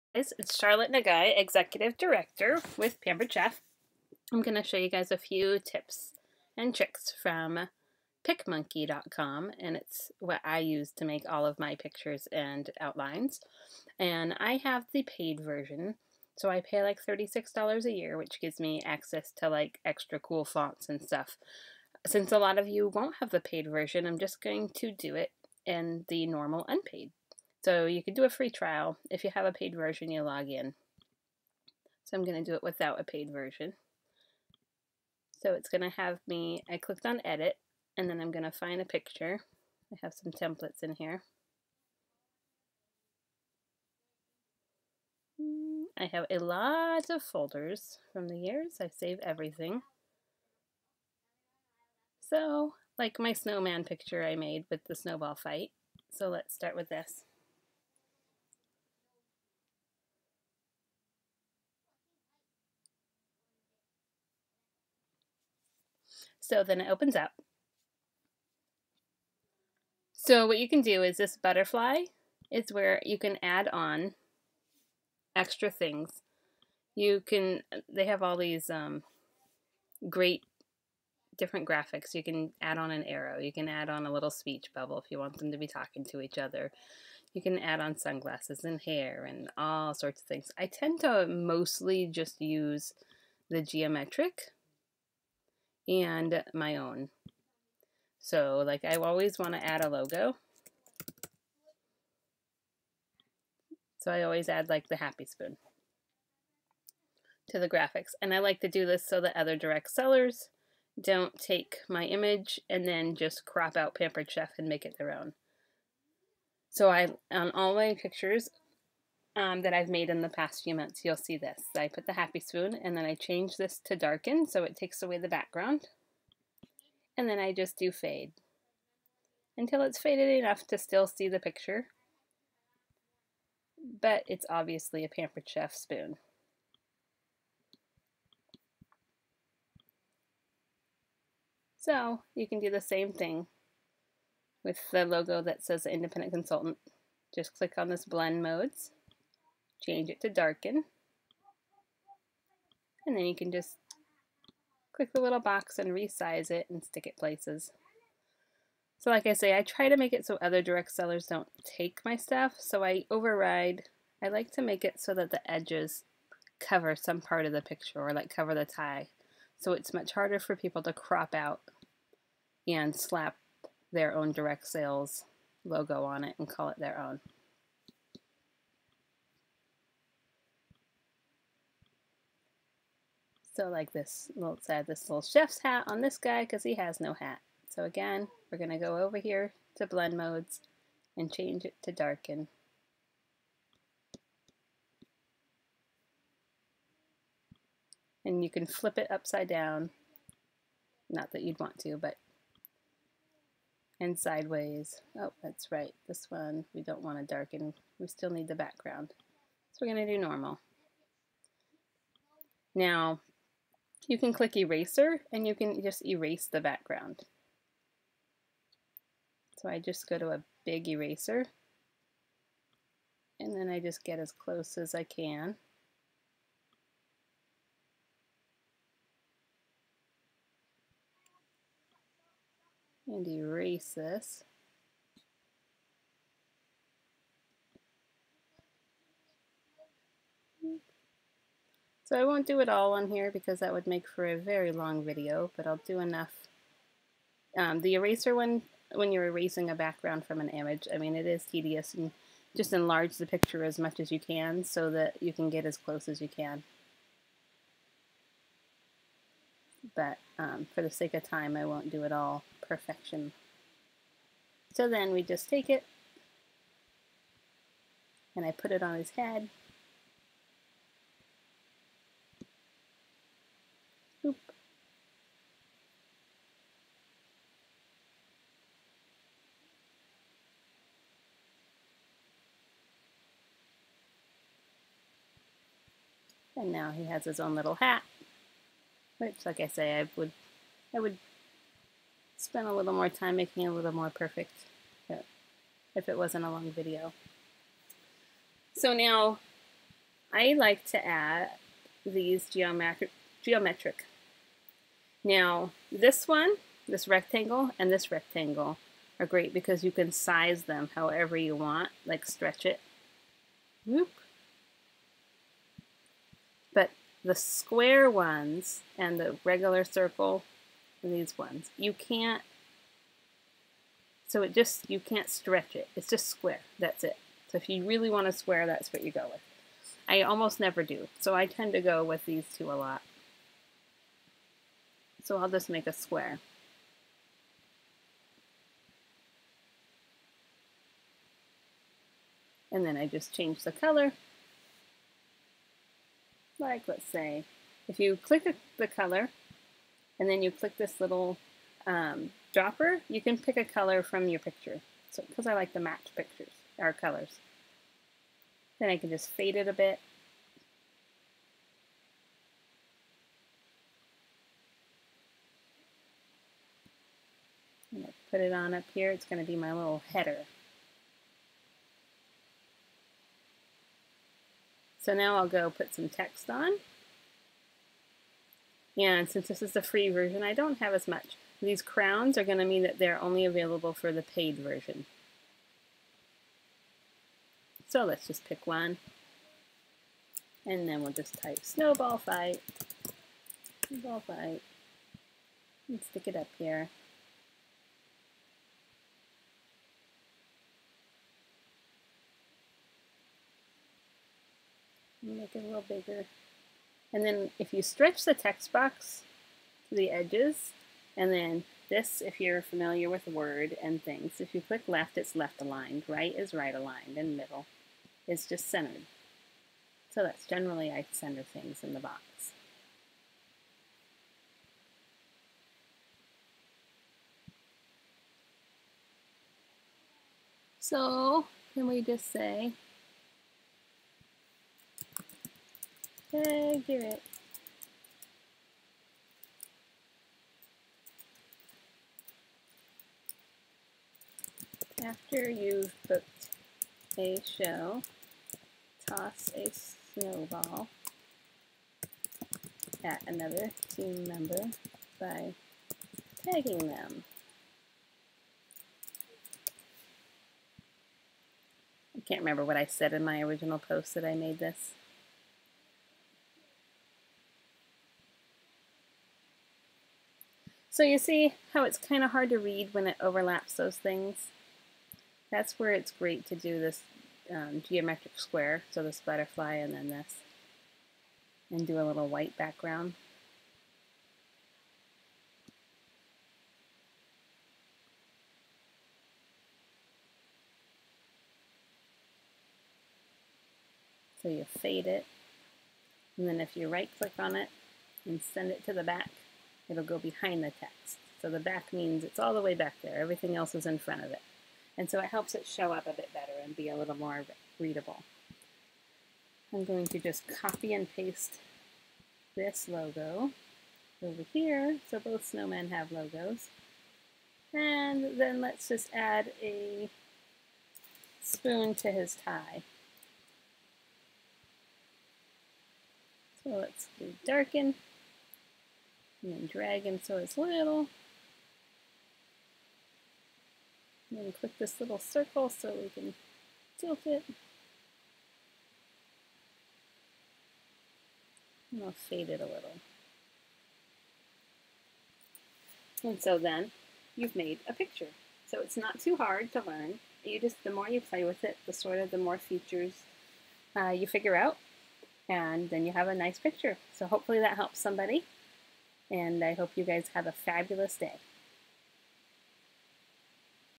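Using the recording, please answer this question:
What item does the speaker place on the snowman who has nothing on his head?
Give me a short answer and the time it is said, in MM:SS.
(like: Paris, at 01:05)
chef's hat, at 03:05.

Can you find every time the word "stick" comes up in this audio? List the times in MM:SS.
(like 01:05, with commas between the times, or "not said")
02:36, 06:36.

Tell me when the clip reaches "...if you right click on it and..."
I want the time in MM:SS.
08:16.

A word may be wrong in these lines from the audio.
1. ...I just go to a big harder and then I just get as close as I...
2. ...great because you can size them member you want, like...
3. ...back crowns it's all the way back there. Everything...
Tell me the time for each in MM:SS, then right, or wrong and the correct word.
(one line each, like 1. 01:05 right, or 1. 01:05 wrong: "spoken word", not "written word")
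1. 03:39 wrong: "eraser", not "harder"
2. 05:09 wrong: "however", not "member"
3. 08:21 wrong: "means", not "crowns".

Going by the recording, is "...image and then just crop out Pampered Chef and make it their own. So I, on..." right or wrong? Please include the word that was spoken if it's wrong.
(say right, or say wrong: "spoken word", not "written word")
right.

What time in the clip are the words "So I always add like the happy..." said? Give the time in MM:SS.
01:43.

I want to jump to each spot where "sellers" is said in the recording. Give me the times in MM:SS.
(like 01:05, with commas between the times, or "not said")
01:49, 02:40.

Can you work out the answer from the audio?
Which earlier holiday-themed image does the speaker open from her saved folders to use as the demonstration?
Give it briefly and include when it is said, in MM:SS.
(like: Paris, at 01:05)
snowman picture, at 00:53.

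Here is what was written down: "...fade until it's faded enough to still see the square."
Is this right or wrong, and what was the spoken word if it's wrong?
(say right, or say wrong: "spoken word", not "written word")
wrong: "picture", not "square".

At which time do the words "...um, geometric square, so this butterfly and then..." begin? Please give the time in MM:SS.
07:57.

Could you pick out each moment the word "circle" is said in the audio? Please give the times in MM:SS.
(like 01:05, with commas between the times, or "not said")
05:19, 08:55.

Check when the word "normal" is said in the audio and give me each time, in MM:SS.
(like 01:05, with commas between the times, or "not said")
00:26, 03:30.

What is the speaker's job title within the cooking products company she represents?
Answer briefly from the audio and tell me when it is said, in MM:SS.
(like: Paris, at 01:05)
Executive Director, at 00:01.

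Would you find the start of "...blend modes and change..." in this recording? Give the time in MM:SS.
03:09.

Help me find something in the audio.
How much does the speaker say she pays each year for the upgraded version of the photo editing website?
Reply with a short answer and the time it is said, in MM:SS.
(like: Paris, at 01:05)
$36, at 00:17.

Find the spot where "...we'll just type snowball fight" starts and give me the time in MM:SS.
06:31.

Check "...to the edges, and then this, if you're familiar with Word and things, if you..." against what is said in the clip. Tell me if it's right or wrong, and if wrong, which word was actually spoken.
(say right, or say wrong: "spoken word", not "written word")
right.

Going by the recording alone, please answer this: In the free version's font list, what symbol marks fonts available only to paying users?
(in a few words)
crowns.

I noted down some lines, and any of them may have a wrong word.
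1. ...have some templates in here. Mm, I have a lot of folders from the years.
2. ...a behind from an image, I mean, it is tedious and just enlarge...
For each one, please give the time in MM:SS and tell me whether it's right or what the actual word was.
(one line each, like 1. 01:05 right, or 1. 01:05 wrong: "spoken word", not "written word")
1. 00:40 right
2. 04:09 wrong: "background", not "behind".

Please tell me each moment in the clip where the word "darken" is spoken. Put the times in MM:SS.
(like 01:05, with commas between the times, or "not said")
02:03, 02:30, 03:11, 03:27, 08:47.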